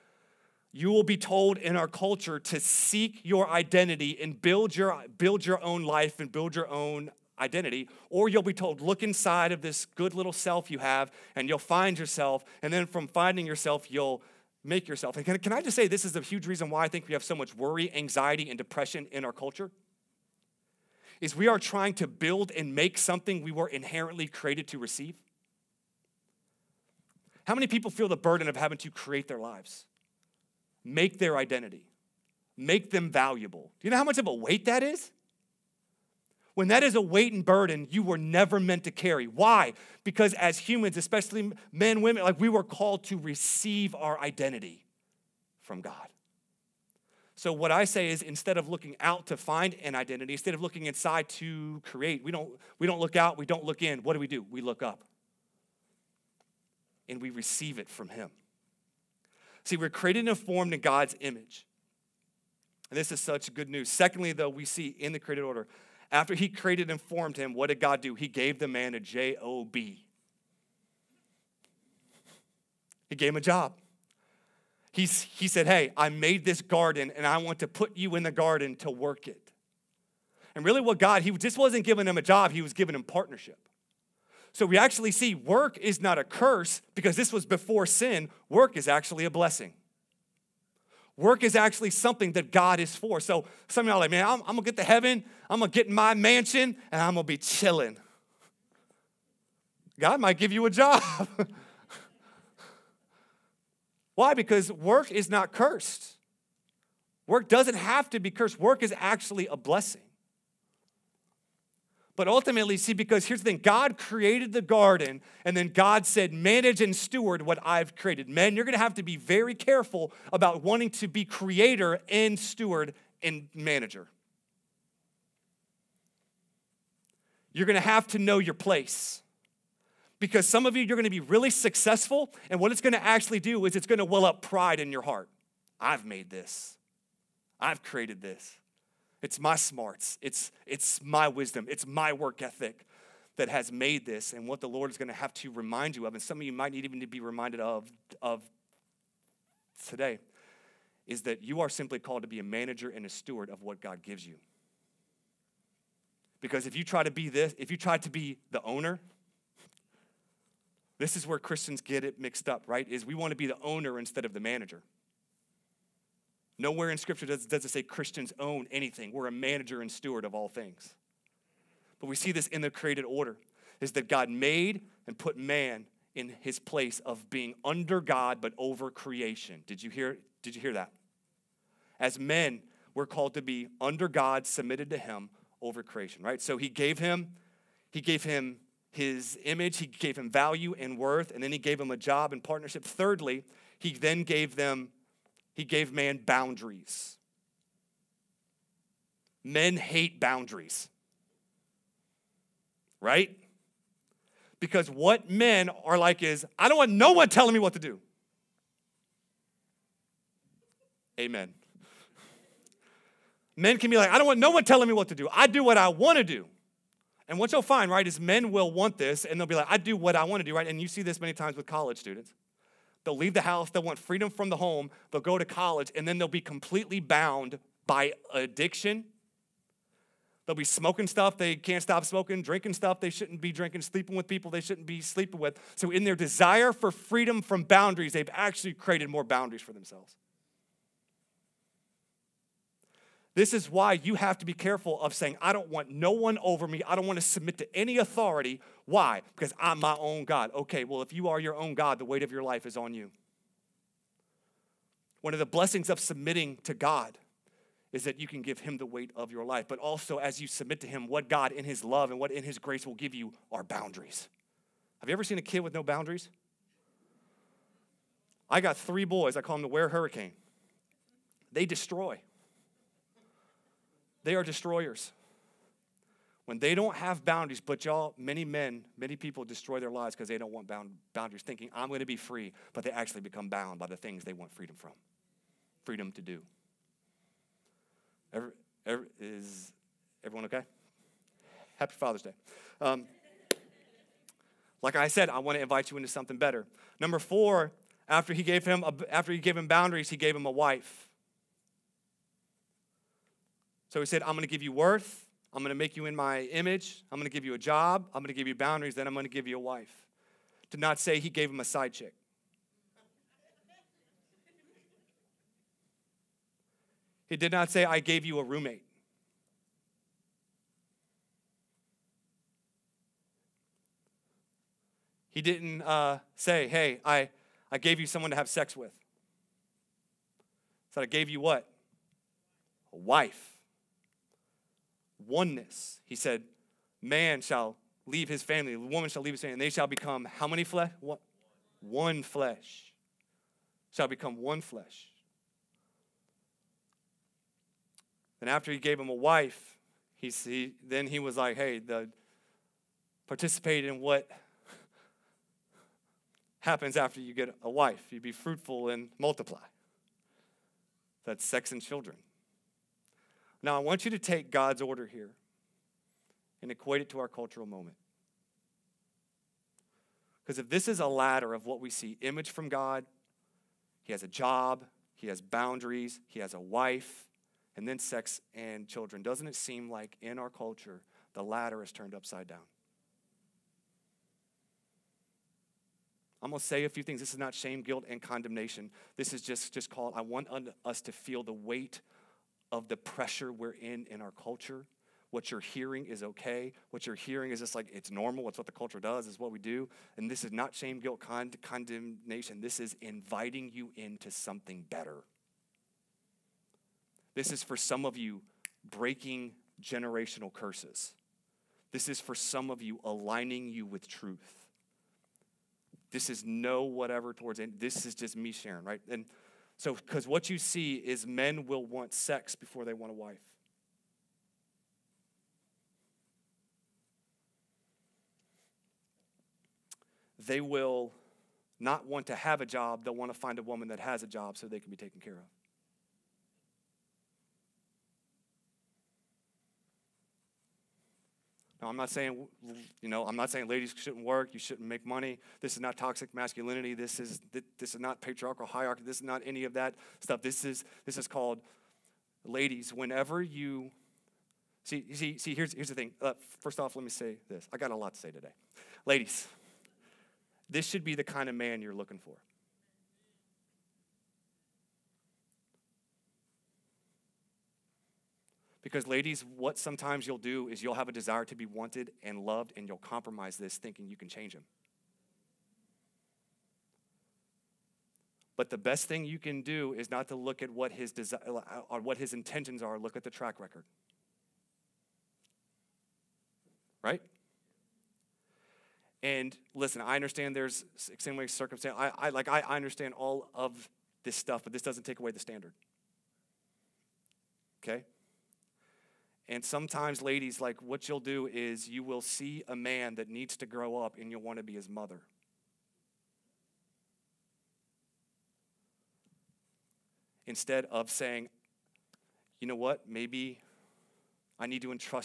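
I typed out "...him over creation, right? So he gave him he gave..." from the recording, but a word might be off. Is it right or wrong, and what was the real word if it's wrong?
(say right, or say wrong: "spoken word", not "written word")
right.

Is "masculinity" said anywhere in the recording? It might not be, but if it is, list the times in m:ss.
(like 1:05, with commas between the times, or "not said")
7:26.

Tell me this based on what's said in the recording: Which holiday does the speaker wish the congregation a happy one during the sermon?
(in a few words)
Father's Day.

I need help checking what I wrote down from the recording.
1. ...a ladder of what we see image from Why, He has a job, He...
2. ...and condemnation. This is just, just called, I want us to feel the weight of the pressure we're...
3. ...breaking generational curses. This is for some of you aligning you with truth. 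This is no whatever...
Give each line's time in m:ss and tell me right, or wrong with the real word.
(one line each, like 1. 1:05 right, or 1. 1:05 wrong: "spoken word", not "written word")
1. 6:10 wrong: "God", not "Why"
2. 6:28 right
3. 6:48 right.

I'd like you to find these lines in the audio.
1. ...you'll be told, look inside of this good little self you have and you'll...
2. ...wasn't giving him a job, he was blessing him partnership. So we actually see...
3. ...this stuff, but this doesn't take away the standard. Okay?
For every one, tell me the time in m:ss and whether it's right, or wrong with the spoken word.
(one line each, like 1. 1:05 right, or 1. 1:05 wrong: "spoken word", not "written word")
1. 0:08 right
2. 1:21 wrong: "giving", not "blessing"
3. 8:14 right.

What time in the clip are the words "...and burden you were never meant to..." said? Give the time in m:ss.
0:37.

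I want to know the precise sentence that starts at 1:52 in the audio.
But ultimately, see, because here's the thing God created the garden, and then God said, manage and steward what I've created.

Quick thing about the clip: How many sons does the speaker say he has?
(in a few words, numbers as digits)
3.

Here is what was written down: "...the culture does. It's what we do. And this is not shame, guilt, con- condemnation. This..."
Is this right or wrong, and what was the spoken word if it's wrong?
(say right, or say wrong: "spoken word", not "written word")
right.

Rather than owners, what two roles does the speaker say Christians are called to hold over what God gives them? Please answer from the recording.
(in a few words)
Manager and steward.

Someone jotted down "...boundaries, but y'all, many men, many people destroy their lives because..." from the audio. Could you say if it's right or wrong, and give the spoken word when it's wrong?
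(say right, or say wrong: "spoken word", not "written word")
right.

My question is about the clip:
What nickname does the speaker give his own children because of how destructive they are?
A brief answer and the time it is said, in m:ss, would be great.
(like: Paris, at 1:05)
Ware Hurricane, at 4:29.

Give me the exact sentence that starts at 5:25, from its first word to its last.
He didn't uh, say, hey, I, I gave you someone to have sex with.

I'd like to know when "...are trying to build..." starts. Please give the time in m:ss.
0:21.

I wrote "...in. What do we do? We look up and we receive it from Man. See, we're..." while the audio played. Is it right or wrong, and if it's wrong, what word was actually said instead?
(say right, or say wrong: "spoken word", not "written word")
wrong: "Him", not "Man".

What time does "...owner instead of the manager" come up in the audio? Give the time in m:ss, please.
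2:43.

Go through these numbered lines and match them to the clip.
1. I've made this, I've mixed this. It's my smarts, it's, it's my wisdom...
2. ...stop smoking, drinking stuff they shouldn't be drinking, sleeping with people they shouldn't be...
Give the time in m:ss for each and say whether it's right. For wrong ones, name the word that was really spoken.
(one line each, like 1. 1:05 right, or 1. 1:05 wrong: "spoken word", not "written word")
1. 2:15 wrong: "created", not "mixed"
2. 3:51 right.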